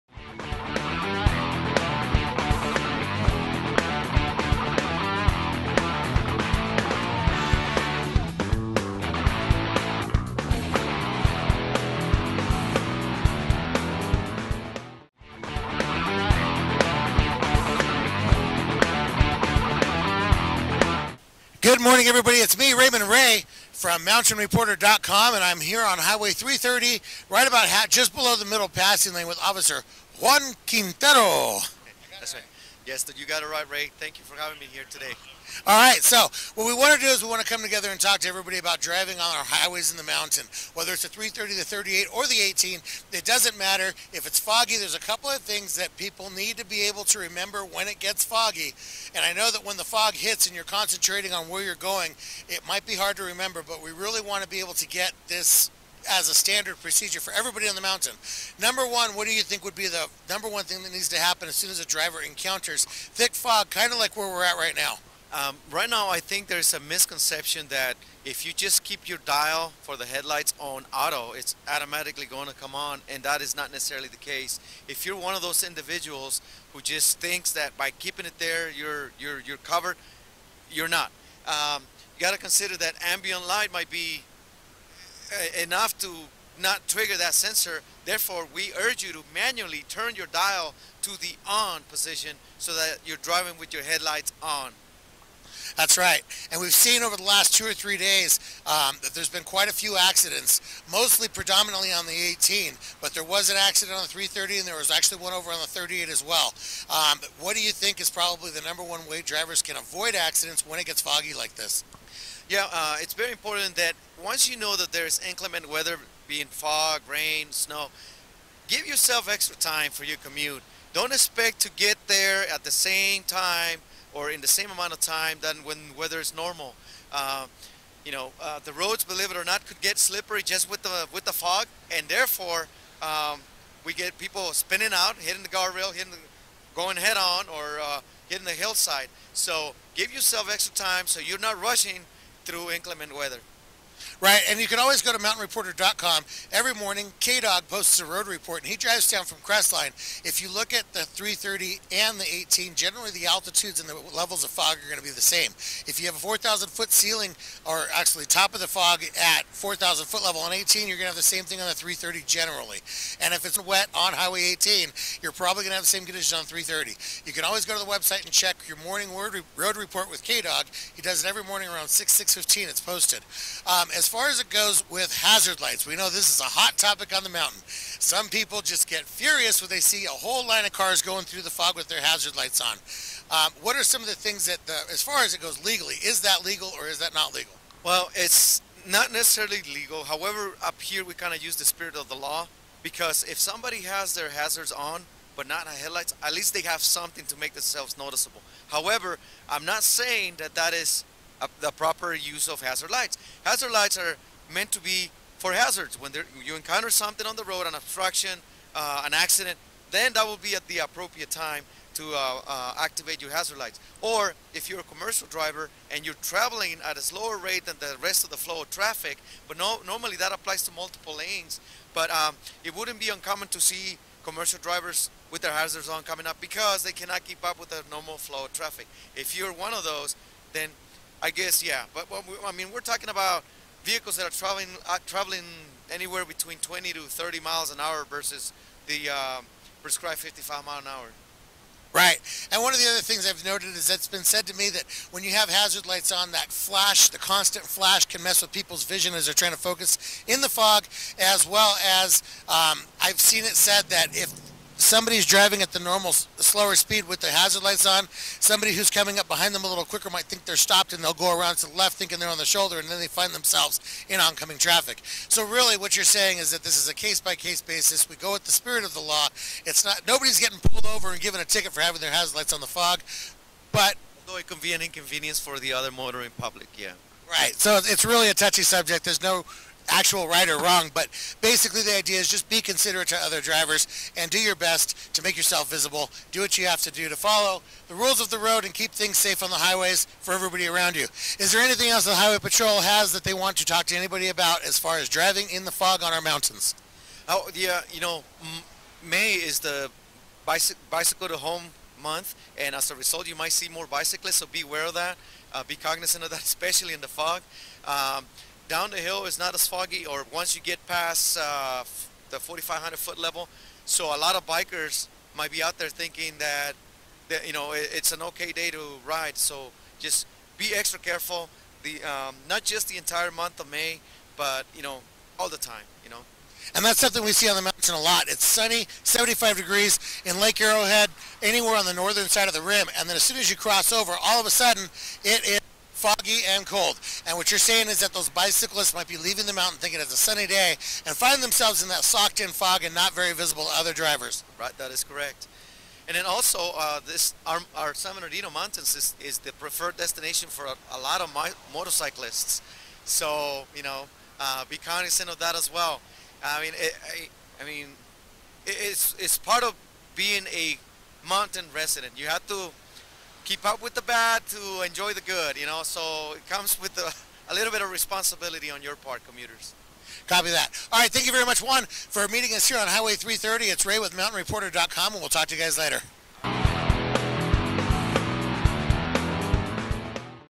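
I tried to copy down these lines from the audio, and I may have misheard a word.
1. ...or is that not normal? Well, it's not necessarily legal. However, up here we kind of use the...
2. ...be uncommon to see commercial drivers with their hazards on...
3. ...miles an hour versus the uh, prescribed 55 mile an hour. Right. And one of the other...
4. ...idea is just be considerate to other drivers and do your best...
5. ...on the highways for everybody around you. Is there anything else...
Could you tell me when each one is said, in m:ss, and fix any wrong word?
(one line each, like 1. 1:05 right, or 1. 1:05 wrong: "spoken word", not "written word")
1. 3:06 wrong: "legal", not "normal"
2. 3:42 right
3. 3:57 right
4. 4:41 right
5. 4:49 right.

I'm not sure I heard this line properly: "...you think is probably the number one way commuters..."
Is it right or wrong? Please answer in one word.
wrong.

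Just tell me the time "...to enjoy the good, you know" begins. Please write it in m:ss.
6:04.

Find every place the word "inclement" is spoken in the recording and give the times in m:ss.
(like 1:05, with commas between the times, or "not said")
1:55, 2:22.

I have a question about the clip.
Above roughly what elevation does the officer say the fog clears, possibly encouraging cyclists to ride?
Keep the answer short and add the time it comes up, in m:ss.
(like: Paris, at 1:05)
4,500 feet, at 5:12.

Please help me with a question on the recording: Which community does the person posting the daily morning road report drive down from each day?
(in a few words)
Crestline.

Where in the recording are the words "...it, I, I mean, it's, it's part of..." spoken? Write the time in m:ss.
5:56.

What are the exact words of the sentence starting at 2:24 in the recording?
And you can always go to mountainreporter.com.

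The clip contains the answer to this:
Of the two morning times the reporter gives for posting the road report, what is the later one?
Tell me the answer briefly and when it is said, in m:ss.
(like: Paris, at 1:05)
6:15, at 2:52.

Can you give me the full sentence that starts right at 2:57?
Some people just get furious when they see a whole line of cars going through the fog with their hazard lights on.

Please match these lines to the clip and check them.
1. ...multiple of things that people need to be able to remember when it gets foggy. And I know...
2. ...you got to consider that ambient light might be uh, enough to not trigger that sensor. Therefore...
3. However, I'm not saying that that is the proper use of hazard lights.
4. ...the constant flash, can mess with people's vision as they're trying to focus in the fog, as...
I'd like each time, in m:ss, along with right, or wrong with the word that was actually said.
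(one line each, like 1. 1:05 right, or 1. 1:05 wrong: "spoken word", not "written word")
1. 0:44 wrong: "couple", not "multiple"
2. 1:22 right
3. 3:18 right
4. 4:07 right.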